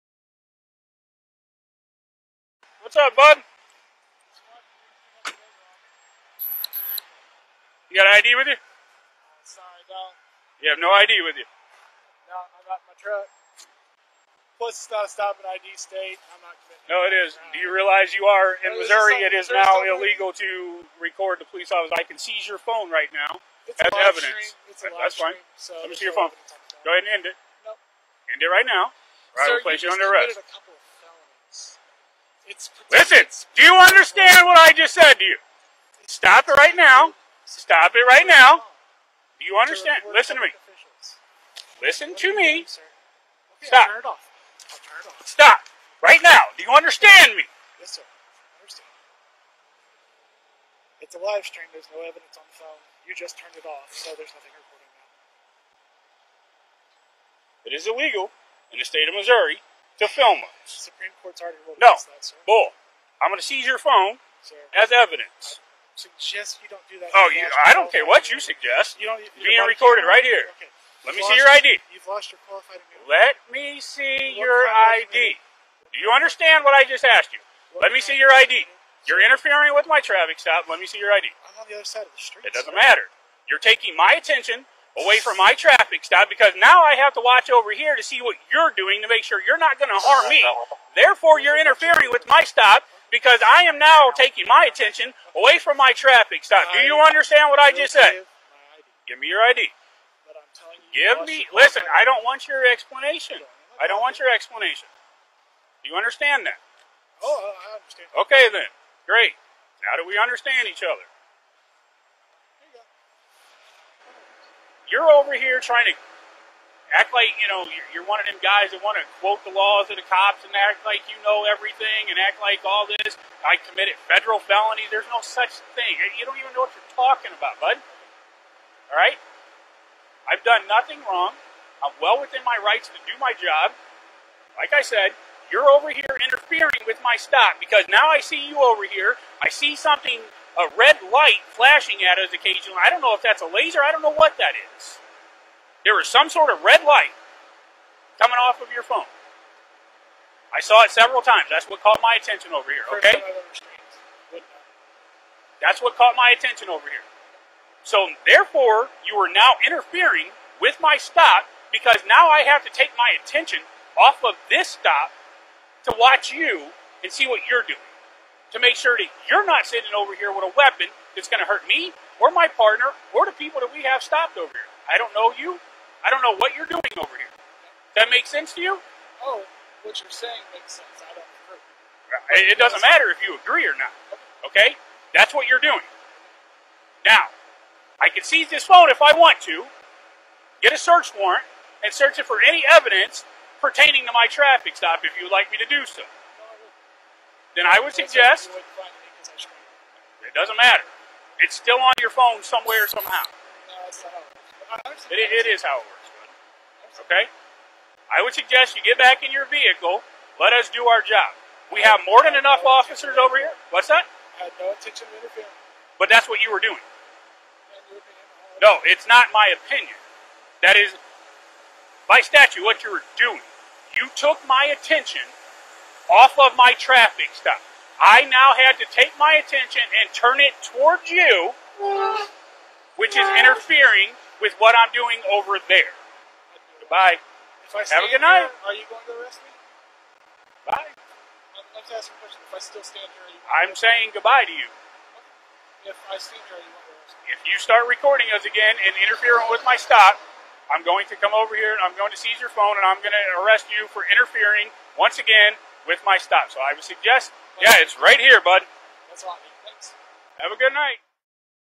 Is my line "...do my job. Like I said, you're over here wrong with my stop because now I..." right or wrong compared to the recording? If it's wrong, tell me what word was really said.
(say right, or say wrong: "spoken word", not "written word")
wrong: "interfering", not "wrong".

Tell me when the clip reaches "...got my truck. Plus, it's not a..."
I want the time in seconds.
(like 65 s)
12 s.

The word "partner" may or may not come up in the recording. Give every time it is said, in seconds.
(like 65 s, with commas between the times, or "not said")
172 s.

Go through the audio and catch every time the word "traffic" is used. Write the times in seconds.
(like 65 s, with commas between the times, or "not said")
80 s, 85 s, 95 s, 194 s, 226 s.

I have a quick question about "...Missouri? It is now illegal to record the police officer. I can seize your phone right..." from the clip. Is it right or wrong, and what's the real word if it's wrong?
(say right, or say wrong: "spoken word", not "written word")
right.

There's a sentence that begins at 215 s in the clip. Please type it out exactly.
But that's what you were doing.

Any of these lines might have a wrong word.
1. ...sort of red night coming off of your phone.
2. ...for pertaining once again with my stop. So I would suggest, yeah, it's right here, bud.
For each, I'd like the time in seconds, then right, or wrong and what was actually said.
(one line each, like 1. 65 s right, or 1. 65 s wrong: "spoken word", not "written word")
1. 146 s wrong: "light", not "night"
2. 253 s wrong: "interfering", not "pertaining".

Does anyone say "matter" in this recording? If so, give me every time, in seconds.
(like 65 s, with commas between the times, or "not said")
82 s, 182 s, 200 s.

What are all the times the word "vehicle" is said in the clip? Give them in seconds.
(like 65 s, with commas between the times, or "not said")
209 s.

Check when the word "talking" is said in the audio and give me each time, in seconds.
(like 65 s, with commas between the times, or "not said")
126 s.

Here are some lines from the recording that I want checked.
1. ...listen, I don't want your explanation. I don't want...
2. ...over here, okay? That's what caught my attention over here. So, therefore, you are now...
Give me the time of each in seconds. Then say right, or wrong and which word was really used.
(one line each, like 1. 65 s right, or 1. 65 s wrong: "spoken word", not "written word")
1. 101 s right
2. 152 s right.